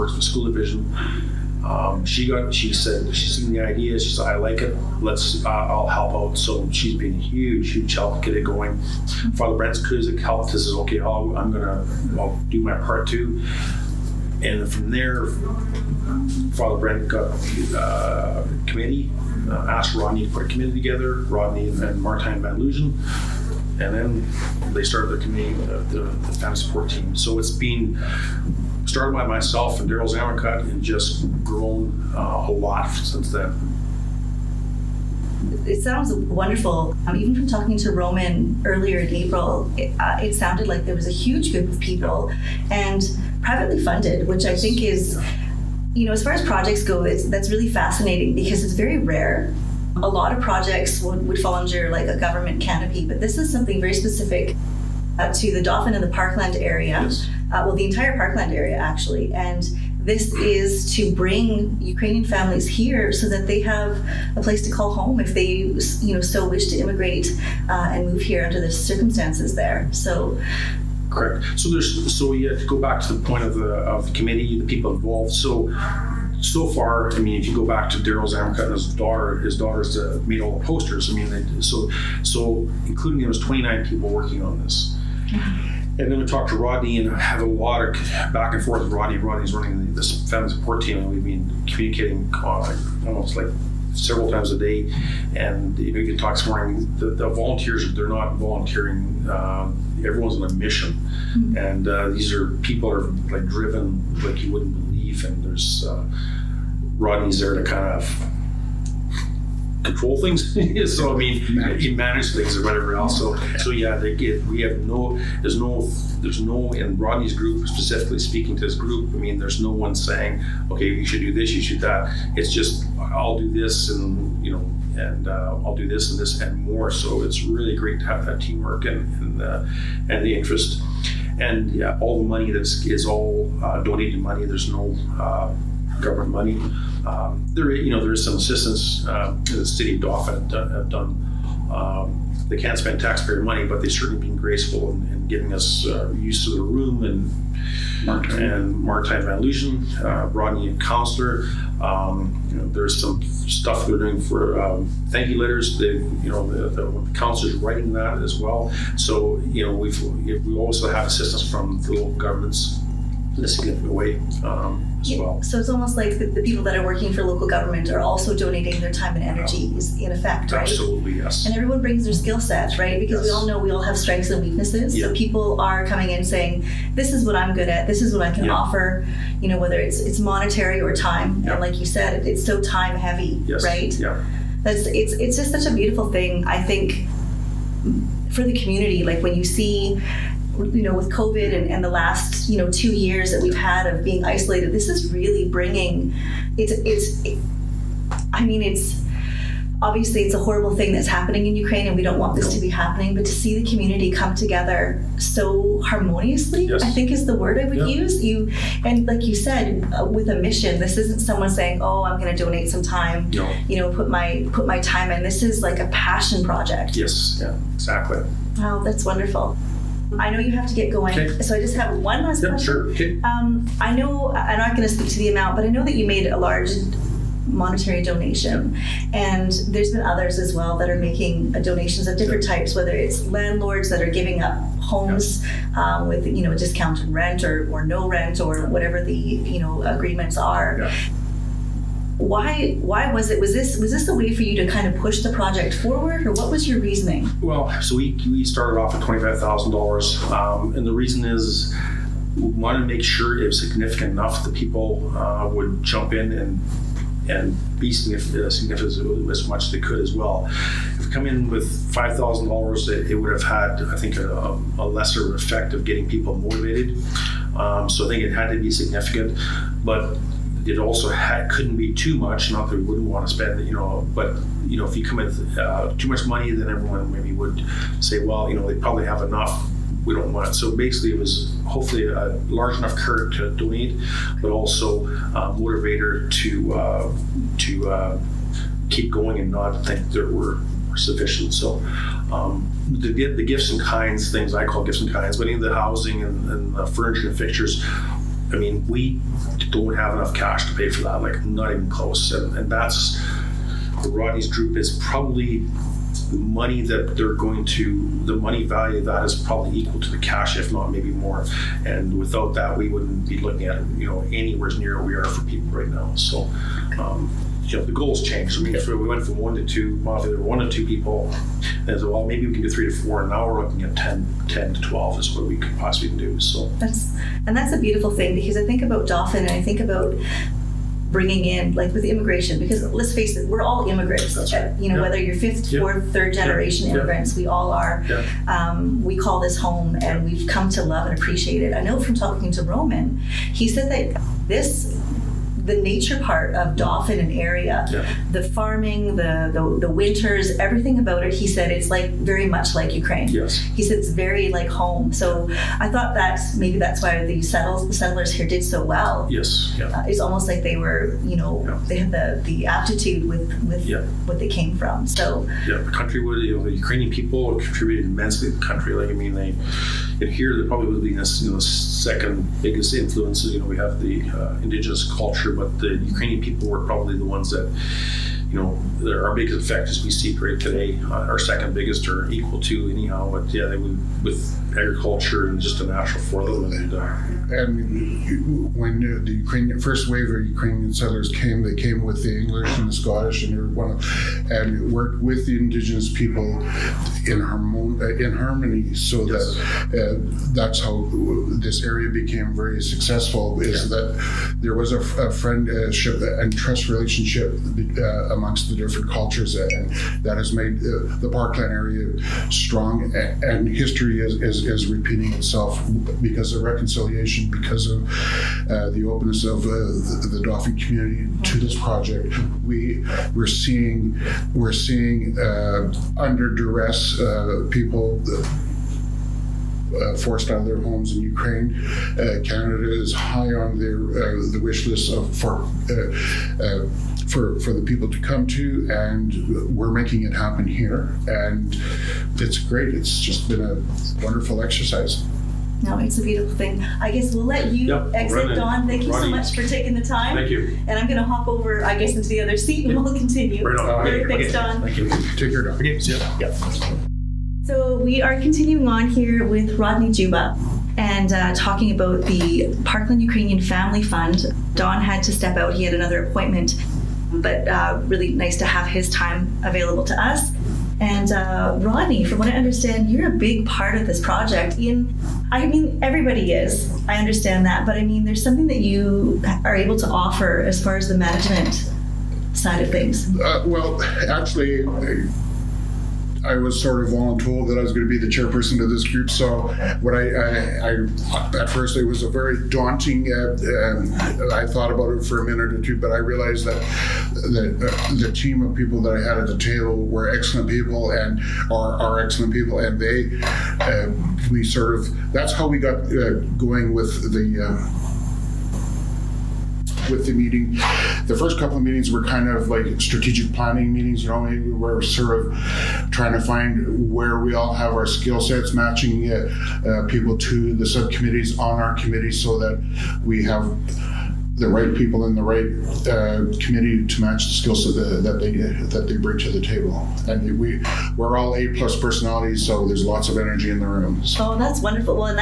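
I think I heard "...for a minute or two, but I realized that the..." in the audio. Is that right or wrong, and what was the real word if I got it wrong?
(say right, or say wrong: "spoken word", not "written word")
right.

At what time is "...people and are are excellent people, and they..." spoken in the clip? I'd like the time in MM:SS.
08:20.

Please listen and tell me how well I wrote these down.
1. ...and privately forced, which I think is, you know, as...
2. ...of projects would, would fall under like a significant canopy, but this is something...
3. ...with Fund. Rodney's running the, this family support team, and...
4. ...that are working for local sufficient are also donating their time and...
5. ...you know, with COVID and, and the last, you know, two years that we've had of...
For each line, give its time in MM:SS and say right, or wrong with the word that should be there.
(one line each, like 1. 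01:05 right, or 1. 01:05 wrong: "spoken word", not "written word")
1. 00:42 wrong: "funded", not "forced"
2. 00:50 wrong: "government", not "significant"
3. 01:28 wrong: "Rodney", not "Fund"
4. 02:46 wrong: "government", not "sufficient"
5. 03:10 right.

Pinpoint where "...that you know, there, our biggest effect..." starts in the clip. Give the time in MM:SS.
06:17.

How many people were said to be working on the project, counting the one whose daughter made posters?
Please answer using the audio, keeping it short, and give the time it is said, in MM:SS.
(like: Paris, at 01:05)
29, at 01:23.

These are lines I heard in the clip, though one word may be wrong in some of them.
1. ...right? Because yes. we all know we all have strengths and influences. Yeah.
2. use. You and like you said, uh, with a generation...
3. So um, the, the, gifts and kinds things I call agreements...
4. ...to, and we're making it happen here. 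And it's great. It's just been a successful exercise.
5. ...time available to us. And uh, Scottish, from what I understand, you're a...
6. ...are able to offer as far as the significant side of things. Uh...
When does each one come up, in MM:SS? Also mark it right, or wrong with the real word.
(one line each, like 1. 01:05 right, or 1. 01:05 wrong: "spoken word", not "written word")
1. 02:52 wrong: "weaknesses", not "influences"
2. 03:27 wrong: "mission", not "generation"
3. 04:51 wrong: "gifts", not "agreements"
4. 07:18 wrong: "wonderful", not "successful"
5. 07:49 wrong: "Rodney", not "Scottish"
6. 07:59 wrong: "management", not "significant".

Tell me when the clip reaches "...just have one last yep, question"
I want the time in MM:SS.
03:41.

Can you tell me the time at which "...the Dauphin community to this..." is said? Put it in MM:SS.
07:00.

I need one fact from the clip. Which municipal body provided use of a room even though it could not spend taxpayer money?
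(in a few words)
City of Dauphin.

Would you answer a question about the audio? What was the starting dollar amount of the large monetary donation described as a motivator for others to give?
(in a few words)
$25,000.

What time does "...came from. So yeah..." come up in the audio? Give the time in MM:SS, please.
06:04.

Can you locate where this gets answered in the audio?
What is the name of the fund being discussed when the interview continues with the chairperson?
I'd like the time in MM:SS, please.
07:42.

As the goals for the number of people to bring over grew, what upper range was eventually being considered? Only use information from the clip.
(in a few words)
10 to 12.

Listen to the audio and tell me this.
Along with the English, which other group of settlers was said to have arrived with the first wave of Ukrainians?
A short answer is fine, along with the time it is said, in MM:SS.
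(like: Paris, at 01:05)
Scottish, at 06:32.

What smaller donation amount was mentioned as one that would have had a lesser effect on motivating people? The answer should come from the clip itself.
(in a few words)
$5,000.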